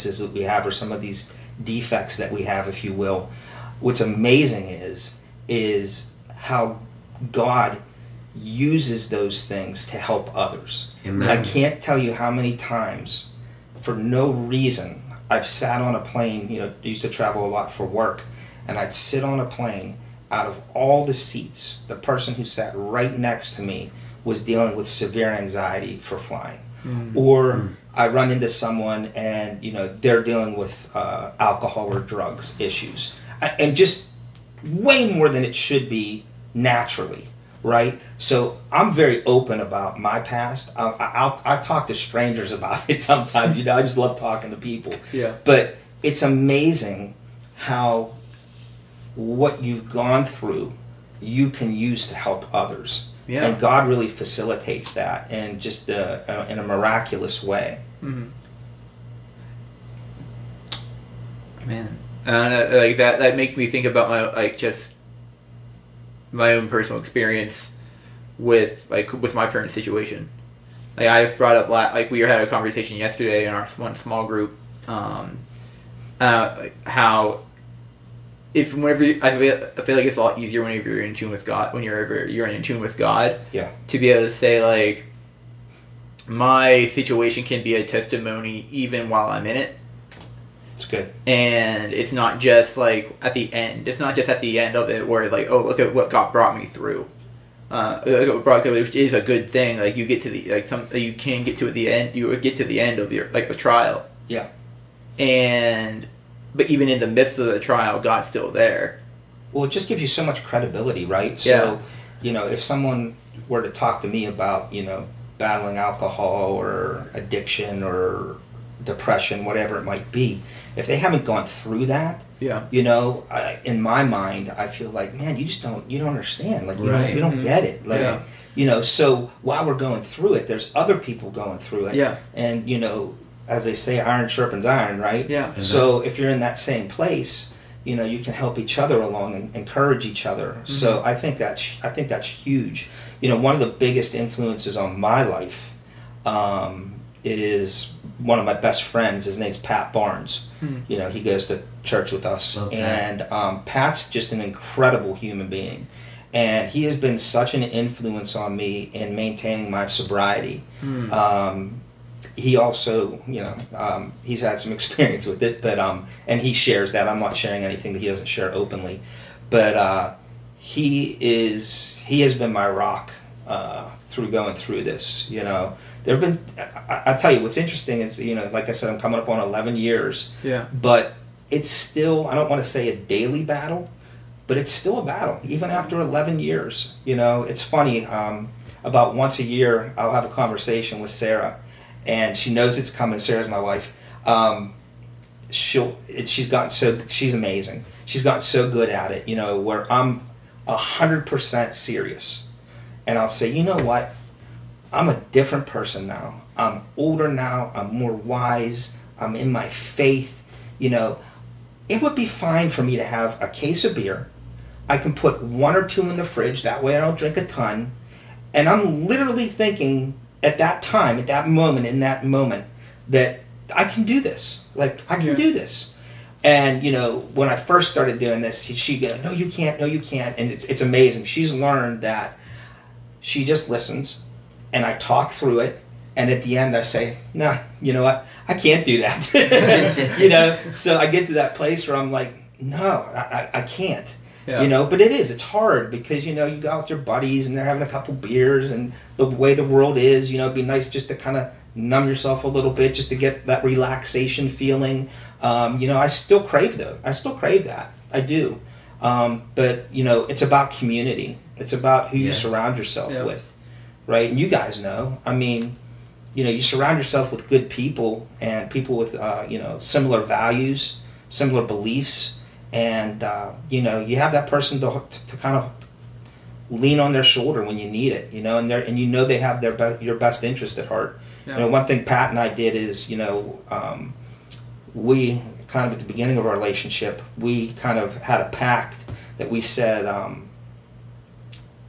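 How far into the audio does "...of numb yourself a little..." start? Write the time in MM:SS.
04:11.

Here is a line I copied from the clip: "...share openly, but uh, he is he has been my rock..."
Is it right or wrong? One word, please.
right.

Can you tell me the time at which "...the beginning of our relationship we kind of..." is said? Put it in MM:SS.
04:45.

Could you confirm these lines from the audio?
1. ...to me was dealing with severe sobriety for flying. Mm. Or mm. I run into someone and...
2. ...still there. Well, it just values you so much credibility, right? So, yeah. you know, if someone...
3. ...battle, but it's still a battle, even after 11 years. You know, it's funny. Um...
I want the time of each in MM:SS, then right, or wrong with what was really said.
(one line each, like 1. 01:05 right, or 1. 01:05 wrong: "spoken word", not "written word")
1. 00:23 wrong: "anxiety", not "sobriety"
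2. 01:48 wrong: "gives", not "values"
3. 03:03 right.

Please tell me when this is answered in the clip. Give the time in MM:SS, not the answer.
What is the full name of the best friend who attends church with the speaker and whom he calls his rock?
02:29.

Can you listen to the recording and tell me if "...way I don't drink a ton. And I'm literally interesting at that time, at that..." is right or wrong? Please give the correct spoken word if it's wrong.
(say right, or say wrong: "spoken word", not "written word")
wrong: "thinking", not "interesting".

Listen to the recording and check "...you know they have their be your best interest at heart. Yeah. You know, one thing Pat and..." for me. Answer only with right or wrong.
right.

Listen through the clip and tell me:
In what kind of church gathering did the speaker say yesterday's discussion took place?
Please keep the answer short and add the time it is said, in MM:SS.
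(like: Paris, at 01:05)
small group, at 01:13.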